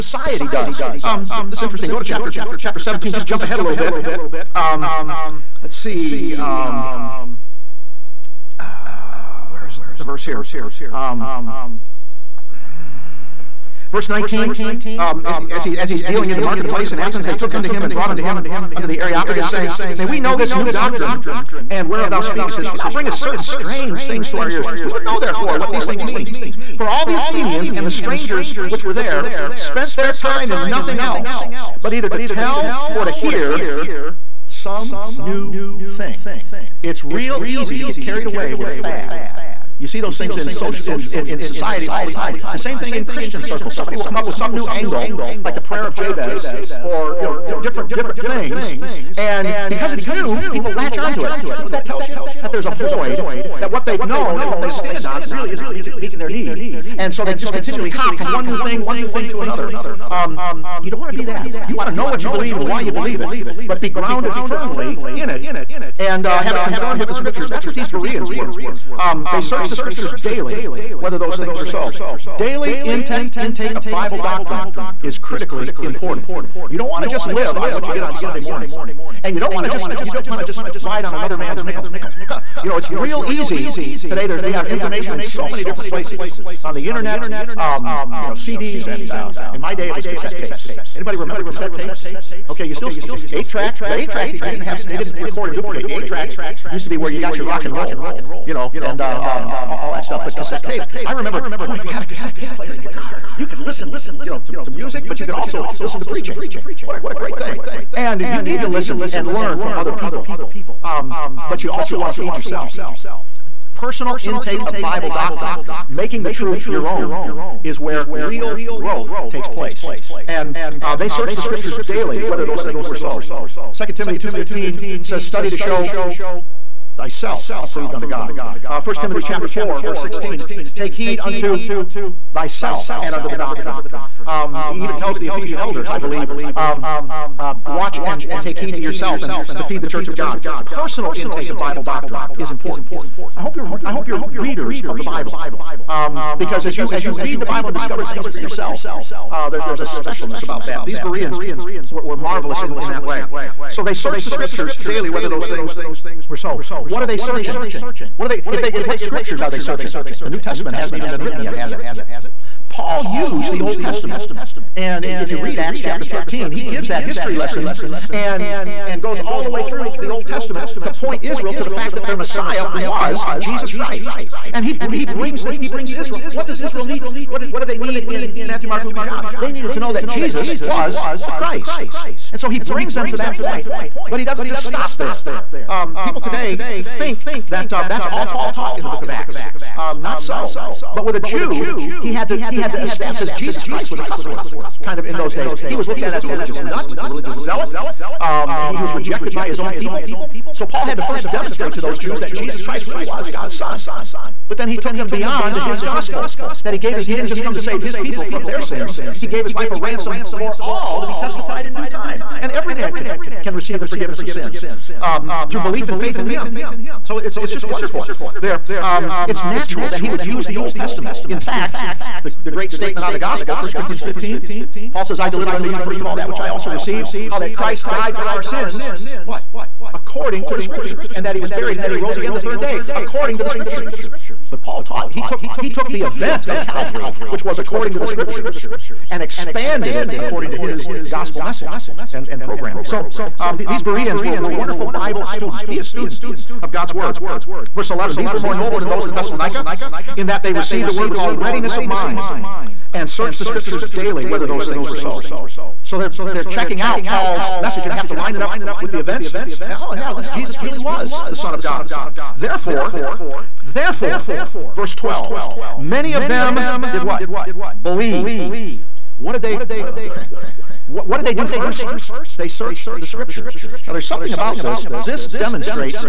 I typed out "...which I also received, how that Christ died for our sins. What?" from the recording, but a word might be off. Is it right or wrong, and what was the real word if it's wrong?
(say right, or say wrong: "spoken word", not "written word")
right.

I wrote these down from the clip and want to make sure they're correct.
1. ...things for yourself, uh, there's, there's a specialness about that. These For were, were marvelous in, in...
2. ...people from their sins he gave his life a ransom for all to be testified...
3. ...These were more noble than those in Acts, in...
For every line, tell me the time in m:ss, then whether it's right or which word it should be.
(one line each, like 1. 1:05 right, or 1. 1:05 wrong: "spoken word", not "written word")
1. 2:28 wrong: "Bereans", not "For"
2. 3:27 right
3. 4:08 wrong: "Thessalonica", not "Acts".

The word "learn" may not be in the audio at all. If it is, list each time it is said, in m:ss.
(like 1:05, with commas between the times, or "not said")
1:49.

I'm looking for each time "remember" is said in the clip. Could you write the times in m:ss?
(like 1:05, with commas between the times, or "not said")
1:31, 1:41.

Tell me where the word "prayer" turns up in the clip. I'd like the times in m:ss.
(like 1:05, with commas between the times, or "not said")
0:45.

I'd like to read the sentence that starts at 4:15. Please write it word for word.
So they're, they're checking out Paul's message and have to line it up with the events.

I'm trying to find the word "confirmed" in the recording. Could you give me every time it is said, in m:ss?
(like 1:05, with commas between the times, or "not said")
1:06.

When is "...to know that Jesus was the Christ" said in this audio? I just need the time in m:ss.
2:59.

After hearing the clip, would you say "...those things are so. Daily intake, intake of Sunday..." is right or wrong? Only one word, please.
wrong.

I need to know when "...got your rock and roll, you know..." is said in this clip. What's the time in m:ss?
1:37.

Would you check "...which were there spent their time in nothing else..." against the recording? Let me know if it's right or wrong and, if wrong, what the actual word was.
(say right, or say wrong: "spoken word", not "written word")
right.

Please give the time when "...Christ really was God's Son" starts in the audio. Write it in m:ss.
3:22.